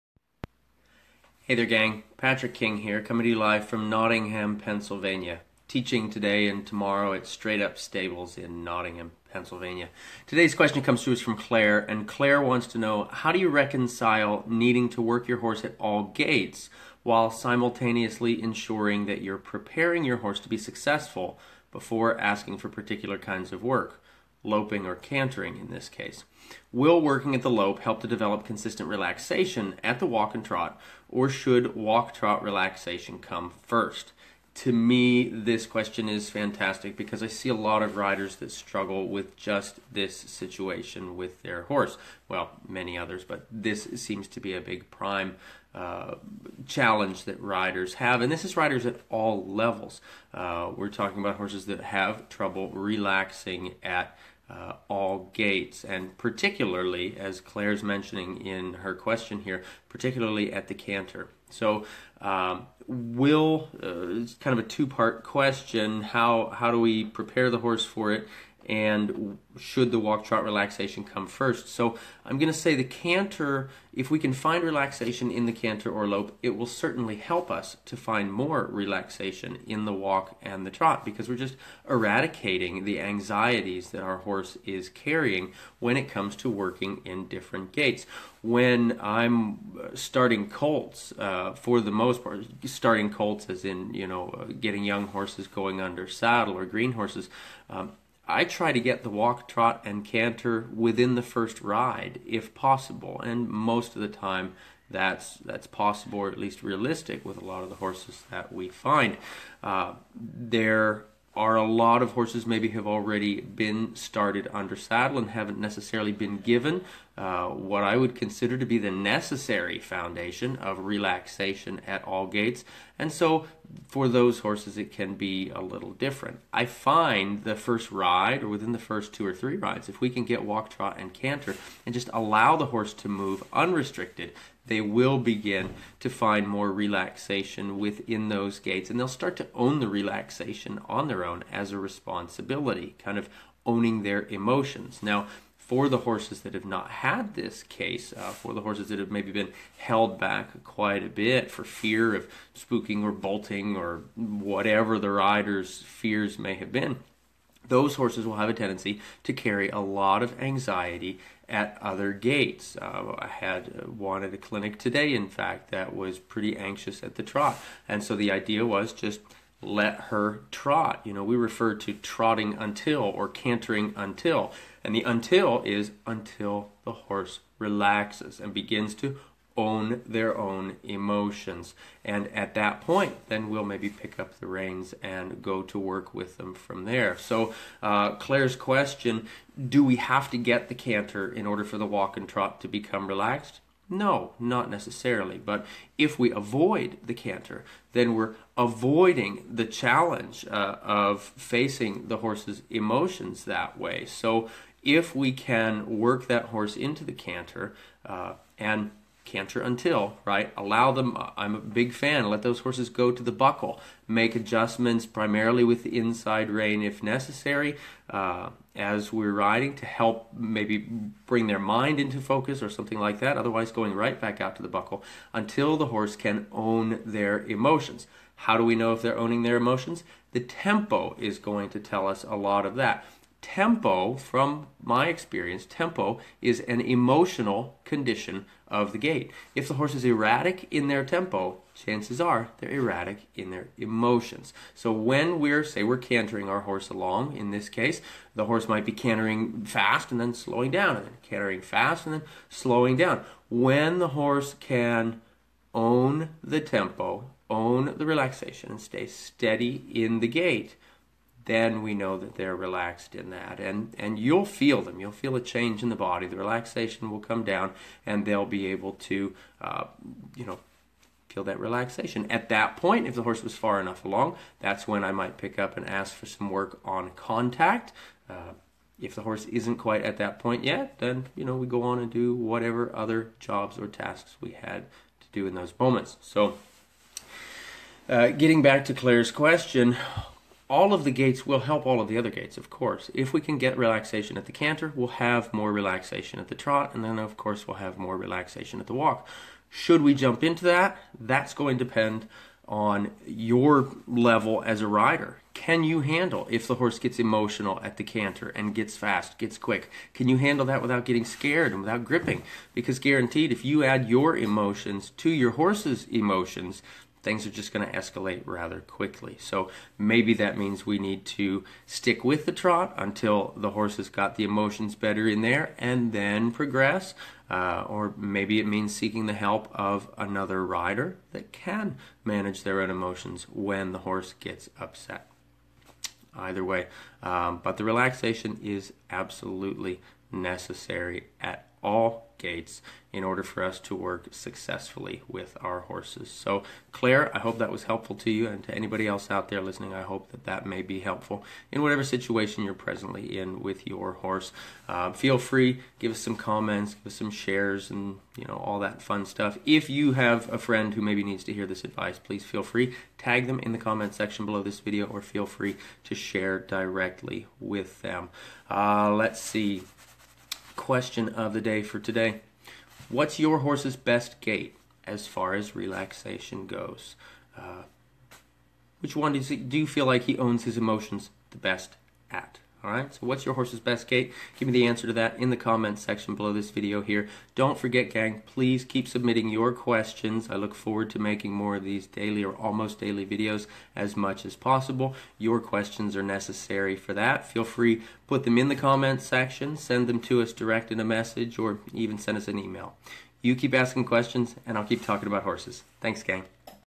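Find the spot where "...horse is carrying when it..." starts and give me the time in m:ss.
1:24.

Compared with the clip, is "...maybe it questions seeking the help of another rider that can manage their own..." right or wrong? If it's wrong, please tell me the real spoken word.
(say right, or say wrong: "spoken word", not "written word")
wrong: "means", not "questions".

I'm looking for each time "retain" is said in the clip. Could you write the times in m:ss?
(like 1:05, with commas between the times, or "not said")
not said.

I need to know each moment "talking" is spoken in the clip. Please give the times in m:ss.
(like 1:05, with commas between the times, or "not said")
0:50, 6:45.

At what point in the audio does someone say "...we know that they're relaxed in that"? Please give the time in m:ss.
4:21.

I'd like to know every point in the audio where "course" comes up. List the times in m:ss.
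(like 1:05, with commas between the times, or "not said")
4:52, 4:57.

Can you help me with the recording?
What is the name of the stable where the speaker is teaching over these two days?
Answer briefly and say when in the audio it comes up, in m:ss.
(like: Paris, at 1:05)
Straight Up Stables, at 0:07.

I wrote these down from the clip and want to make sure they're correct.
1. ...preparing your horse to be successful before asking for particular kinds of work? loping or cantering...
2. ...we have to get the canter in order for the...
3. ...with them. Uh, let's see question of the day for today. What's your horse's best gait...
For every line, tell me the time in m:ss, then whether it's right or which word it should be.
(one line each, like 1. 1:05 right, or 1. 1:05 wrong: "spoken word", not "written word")
1. 0:19 right
2. 3:09 right
3. 6:07 right.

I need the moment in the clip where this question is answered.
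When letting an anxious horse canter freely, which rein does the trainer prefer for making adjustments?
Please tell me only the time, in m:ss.
3:35.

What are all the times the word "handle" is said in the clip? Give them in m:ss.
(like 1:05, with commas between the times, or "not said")
5:06, 5:10.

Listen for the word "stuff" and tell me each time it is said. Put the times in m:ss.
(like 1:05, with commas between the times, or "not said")
5:59.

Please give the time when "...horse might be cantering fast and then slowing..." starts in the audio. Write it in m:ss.
4:08.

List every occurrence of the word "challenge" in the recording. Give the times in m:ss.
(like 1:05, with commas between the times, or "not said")
0:46, 3:19.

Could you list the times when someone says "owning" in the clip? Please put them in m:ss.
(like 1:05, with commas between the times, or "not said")
2:23, 3:49.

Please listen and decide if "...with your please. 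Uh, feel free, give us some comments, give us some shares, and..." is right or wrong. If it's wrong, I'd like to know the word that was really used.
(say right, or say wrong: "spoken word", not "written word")
wrong: "horse", not "please".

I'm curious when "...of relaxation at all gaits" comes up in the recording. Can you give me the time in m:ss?
2:00.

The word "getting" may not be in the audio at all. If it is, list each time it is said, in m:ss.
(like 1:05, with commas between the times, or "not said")
1:34, 4:48, 5:11.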